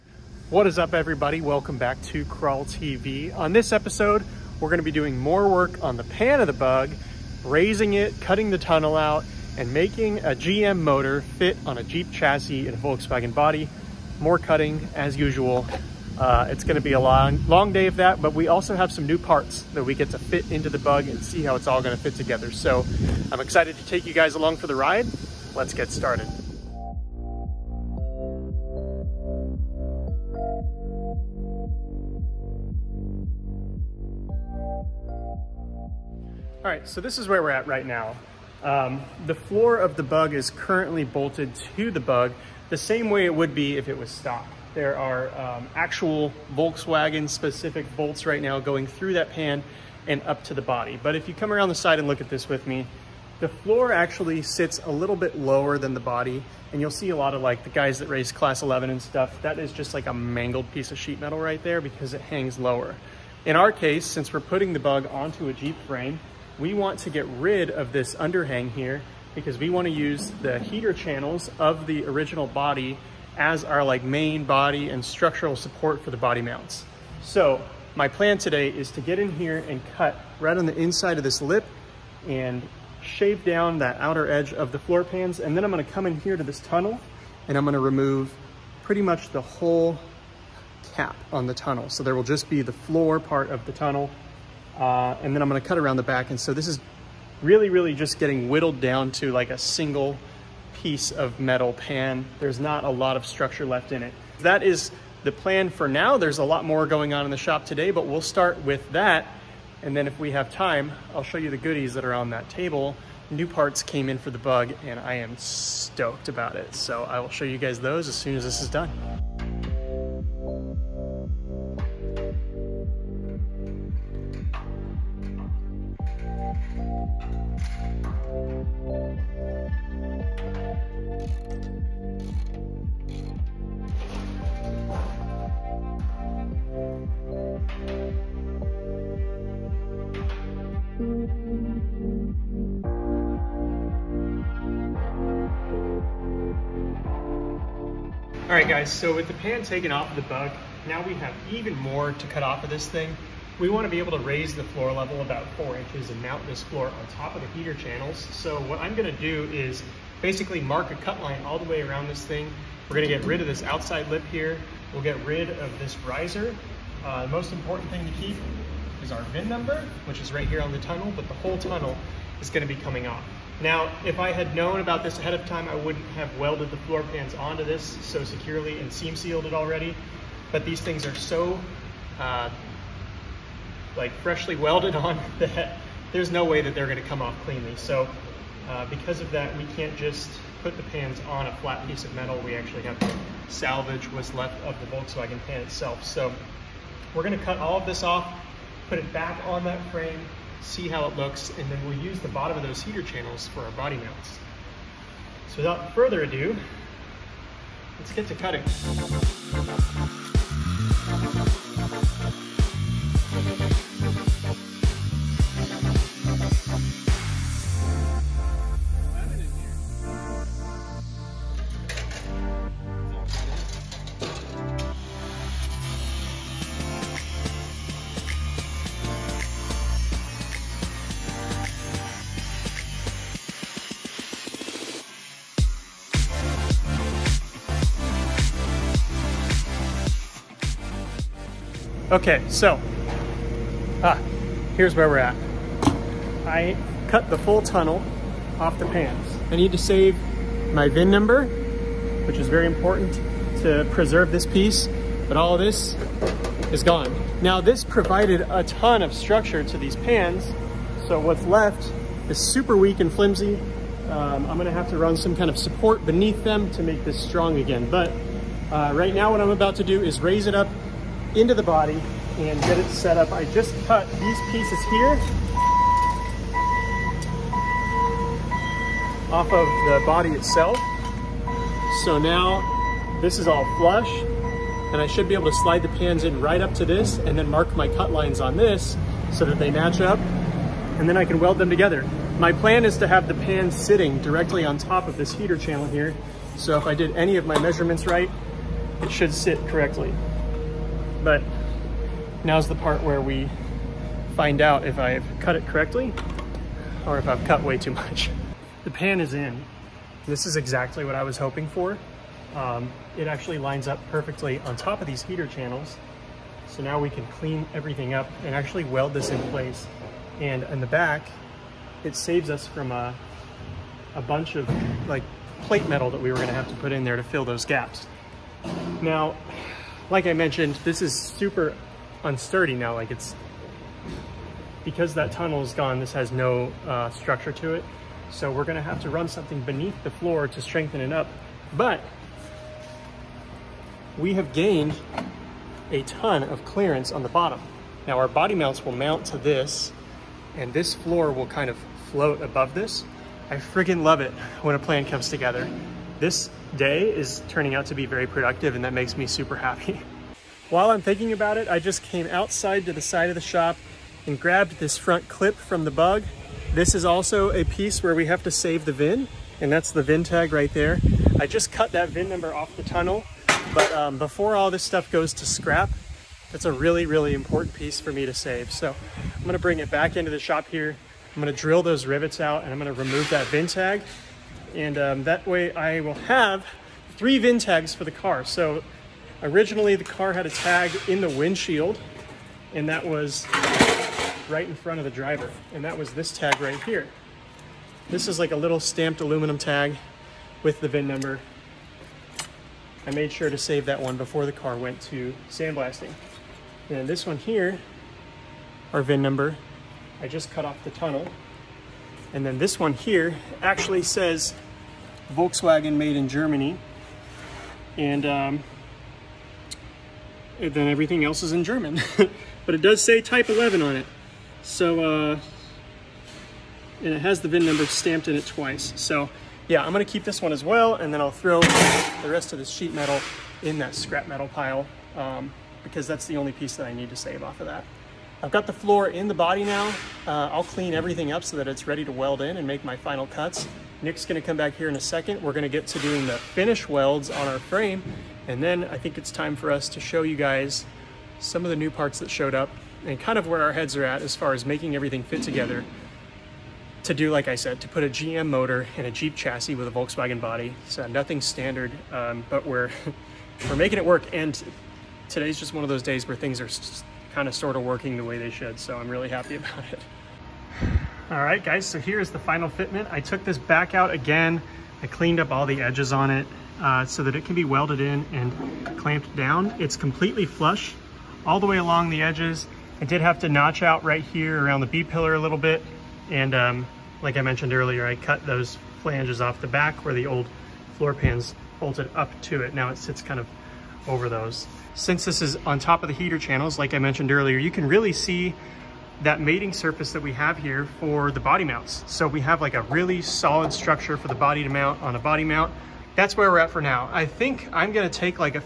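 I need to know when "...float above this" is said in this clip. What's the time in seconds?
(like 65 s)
352 s.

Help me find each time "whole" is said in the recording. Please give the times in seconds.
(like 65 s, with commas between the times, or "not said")
89 s, 171 s.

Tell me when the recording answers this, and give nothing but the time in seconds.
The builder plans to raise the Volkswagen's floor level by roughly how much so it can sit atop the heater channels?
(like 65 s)
155 s.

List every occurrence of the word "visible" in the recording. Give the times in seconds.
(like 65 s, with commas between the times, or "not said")
not said.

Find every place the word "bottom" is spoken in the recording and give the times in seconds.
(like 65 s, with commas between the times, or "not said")
202 s, 347 s.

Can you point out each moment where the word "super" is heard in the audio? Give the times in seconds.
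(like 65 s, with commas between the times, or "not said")
262 s, 331 s, 359 s.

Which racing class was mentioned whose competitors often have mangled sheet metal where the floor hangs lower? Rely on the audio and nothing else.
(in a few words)
Class 11.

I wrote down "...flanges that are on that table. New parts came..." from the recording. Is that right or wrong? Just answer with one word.
wrong.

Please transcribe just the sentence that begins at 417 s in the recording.
And, um, then everything else is in German.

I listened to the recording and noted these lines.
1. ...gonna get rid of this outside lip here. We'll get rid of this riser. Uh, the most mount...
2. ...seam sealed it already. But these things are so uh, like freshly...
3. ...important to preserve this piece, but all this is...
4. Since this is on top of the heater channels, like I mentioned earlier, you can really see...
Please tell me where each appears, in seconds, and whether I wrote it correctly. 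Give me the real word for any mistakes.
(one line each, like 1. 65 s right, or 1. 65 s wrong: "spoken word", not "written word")
1. 162 s wrong: "important", not "mount"
2. 178 s right
3. 252 s right
4. 494 s right.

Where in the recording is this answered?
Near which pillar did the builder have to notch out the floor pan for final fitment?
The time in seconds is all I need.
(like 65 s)
484 s.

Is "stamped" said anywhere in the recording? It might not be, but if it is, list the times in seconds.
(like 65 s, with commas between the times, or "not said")
398 s, 427 s.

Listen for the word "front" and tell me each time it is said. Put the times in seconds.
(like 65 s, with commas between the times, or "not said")
364 s, 394 s.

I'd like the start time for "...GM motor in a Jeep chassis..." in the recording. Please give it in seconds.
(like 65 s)
458 s.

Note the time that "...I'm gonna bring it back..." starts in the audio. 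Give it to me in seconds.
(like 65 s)
379 s.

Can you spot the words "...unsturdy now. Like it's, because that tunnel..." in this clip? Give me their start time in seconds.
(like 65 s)
332 s.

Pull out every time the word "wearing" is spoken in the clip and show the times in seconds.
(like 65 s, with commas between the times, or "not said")
not said.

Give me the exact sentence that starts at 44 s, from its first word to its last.
There are um, actual Volkswagen specific bolts right now going through that pan and up to the body.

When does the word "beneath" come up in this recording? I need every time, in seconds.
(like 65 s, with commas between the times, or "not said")
266 s, 339 s.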